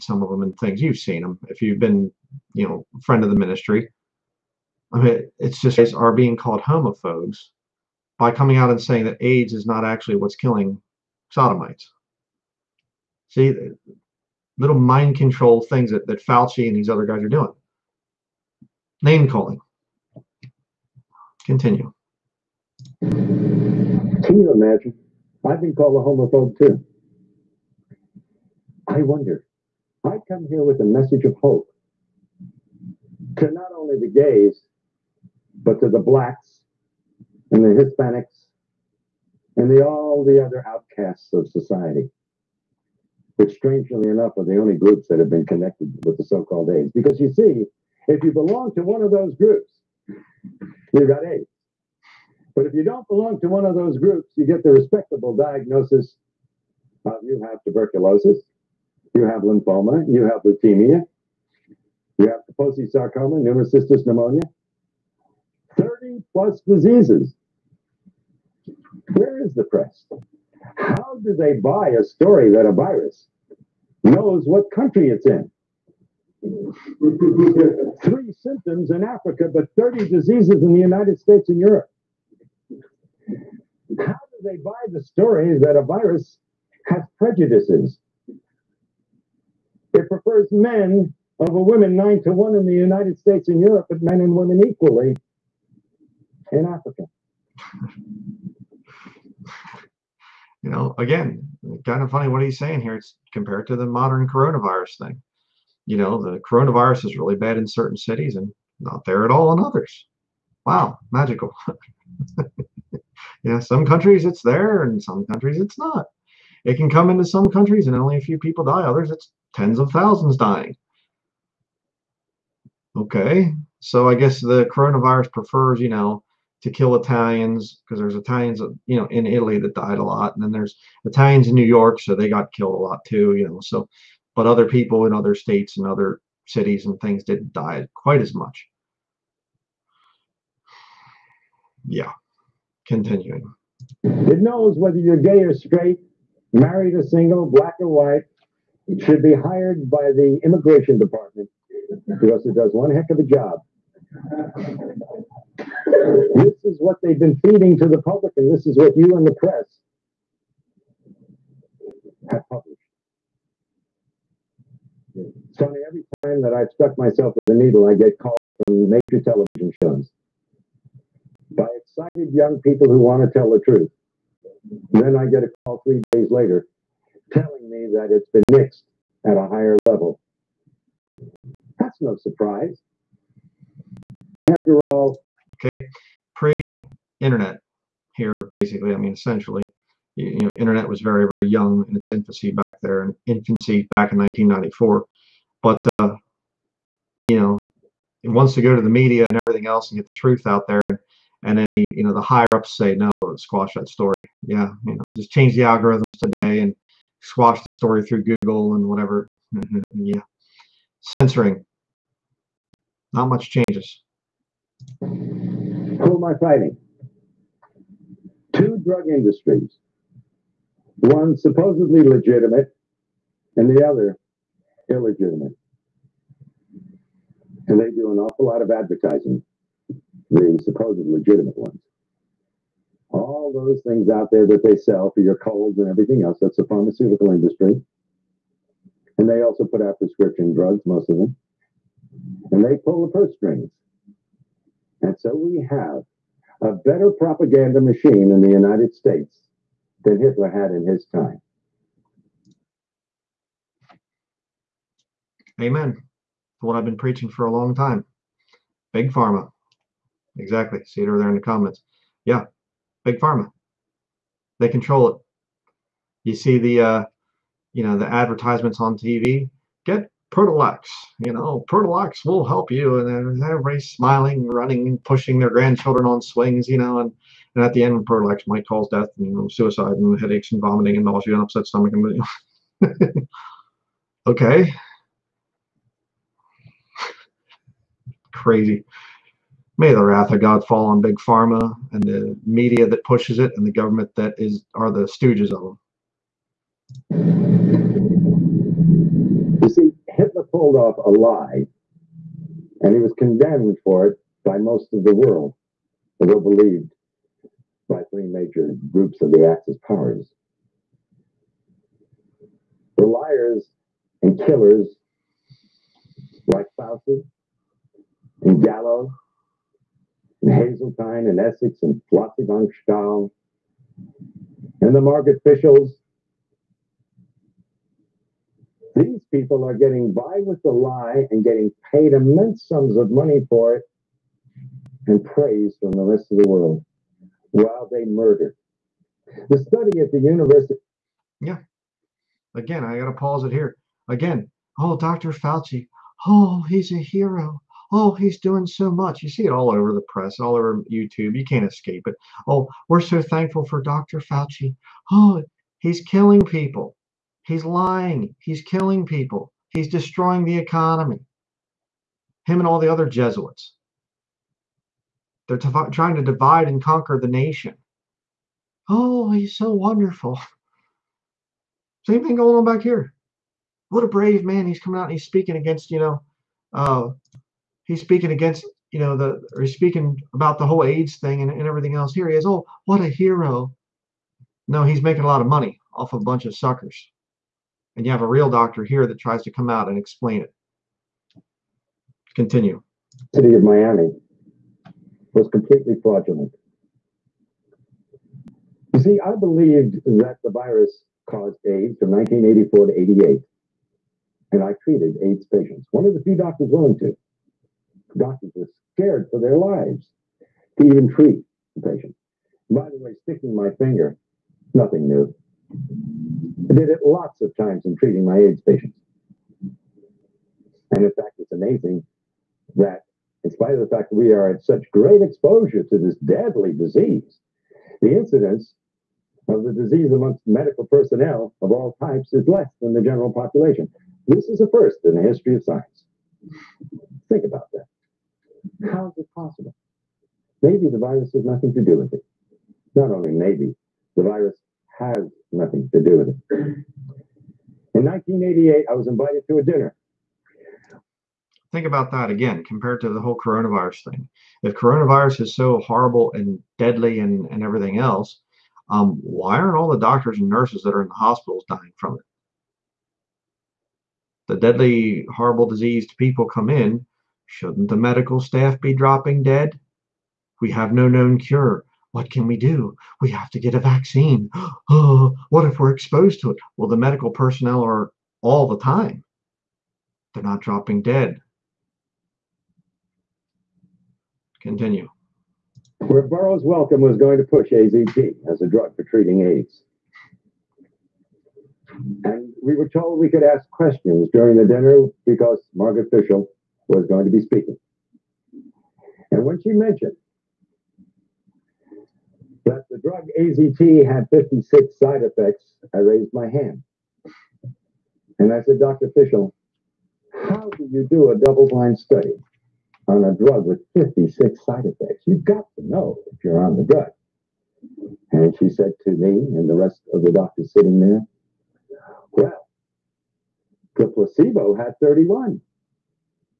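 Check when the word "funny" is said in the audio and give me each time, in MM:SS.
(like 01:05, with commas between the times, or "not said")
01:42.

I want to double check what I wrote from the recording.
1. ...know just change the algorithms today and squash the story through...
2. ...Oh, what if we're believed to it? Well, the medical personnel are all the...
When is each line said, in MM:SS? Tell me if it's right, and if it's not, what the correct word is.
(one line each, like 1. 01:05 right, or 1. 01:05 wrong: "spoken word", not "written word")
1. 03:24 right
2. 07:54 wrong: "exposed", not "believed".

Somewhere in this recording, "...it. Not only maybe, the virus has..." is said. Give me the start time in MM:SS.
07:22.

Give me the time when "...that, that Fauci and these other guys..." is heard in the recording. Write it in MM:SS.
00:15.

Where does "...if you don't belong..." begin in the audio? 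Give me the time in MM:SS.
00:52.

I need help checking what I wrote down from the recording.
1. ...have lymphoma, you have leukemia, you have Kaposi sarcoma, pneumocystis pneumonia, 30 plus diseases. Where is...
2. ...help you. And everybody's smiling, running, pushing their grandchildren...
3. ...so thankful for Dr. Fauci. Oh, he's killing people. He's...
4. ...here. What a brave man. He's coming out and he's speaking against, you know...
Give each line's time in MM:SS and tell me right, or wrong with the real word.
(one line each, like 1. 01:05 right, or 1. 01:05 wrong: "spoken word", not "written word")
1. 00:59 right
2. 04:32 right
3. 05:53 right
4. 06:12 right.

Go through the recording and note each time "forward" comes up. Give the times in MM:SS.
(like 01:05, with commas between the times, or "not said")
not said.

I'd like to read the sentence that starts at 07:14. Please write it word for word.
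This is a first in the history of science.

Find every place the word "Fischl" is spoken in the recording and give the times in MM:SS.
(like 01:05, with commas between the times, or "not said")
08:16, 08:29.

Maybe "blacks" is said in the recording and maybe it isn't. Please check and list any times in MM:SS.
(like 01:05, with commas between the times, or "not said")
00:35, 02:27.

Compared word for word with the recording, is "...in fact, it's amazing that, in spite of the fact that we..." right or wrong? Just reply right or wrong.
right.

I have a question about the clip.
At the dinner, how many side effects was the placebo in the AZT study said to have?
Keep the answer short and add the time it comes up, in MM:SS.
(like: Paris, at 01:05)
31, at 08:44.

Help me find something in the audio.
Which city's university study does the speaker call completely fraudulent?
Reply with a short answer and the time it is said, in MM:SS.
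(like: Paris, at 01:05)
Miami, at 06:33.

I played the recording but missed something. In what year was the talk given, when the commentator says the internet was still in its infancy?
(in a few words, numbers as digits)
1994.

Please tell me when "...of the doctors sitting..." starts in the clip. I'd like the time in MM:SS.
08:40.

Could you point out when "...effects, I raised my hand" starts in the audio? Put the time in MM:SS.
08:25.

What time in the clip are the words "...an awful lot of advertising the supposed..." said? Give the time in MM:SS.
03:48.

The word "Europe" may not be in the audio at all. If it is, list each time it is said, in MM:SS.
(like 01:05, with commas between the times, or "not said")
01:21, 01:33.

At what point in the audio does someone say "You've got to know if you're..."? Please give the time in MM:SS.
08:35.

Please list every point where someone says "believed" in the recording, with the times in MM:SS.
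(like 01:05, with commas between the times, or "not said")
05:06, 06:39.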